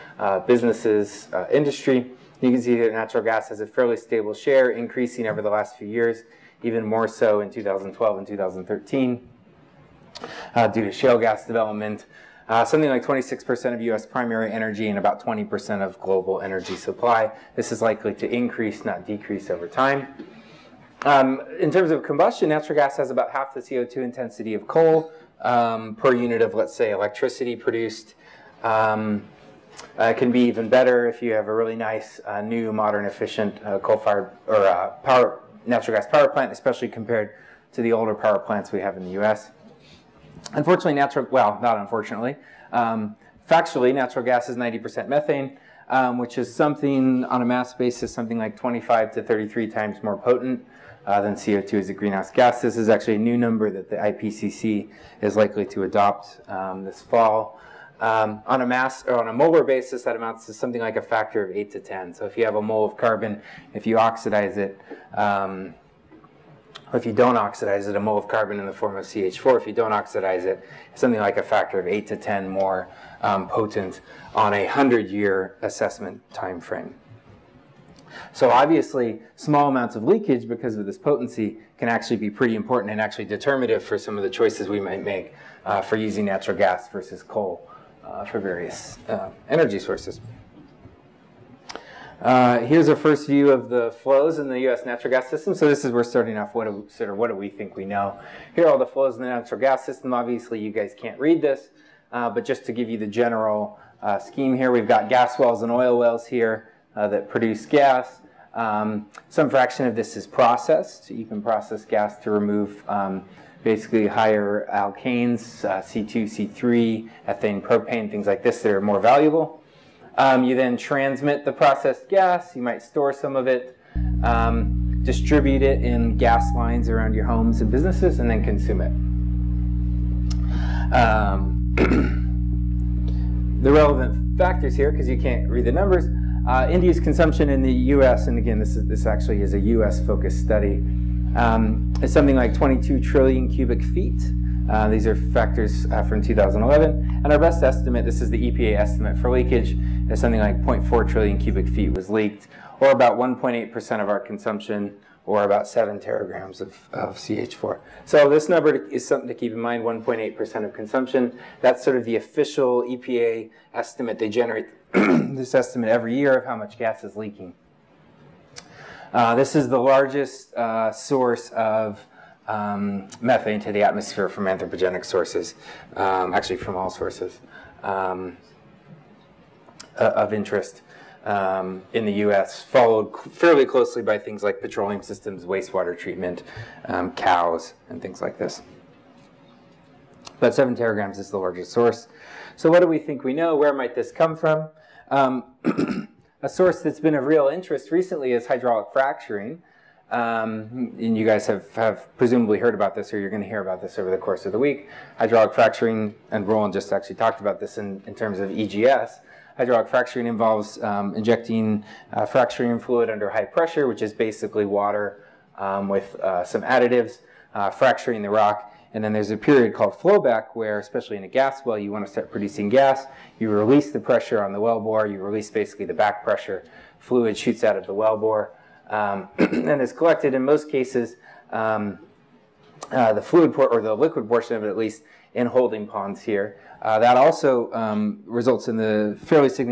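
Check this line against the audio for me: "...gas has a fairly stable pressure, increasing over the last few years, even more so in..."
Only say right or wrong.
wrong.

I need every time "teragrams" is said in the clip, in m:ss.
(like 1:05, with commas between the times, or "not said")
2:35, 3:10.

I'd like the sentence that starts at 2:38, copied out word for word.
So this number is something to keep in mind, 1.8% of consumption.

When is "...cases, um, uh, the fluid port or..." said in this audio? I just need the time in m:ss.
3:50.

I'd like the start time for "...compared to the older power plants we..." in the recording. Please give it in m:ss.
0:36.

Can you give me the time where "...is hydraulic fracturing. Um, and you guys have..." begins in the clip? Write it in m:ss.
3:18.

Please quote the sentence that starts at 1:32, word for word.
Uh, here's a first view of the flows in the U.S.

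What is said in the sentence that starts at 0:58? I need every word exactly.
Um, on a mass or on a molar basis, that amounts to something like a factor of eight to ten.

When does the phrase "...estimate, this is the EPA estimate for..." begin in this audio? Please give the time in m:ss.
2:27.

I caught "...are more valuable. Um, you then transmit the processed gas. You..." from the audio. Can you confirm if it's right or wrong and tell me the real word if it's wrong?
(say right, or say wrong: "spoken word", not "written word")
right.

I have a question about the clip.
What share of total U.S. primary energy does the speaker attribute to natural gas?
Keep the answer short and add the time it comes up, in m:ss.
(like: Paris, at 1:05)
26%, at 0:13.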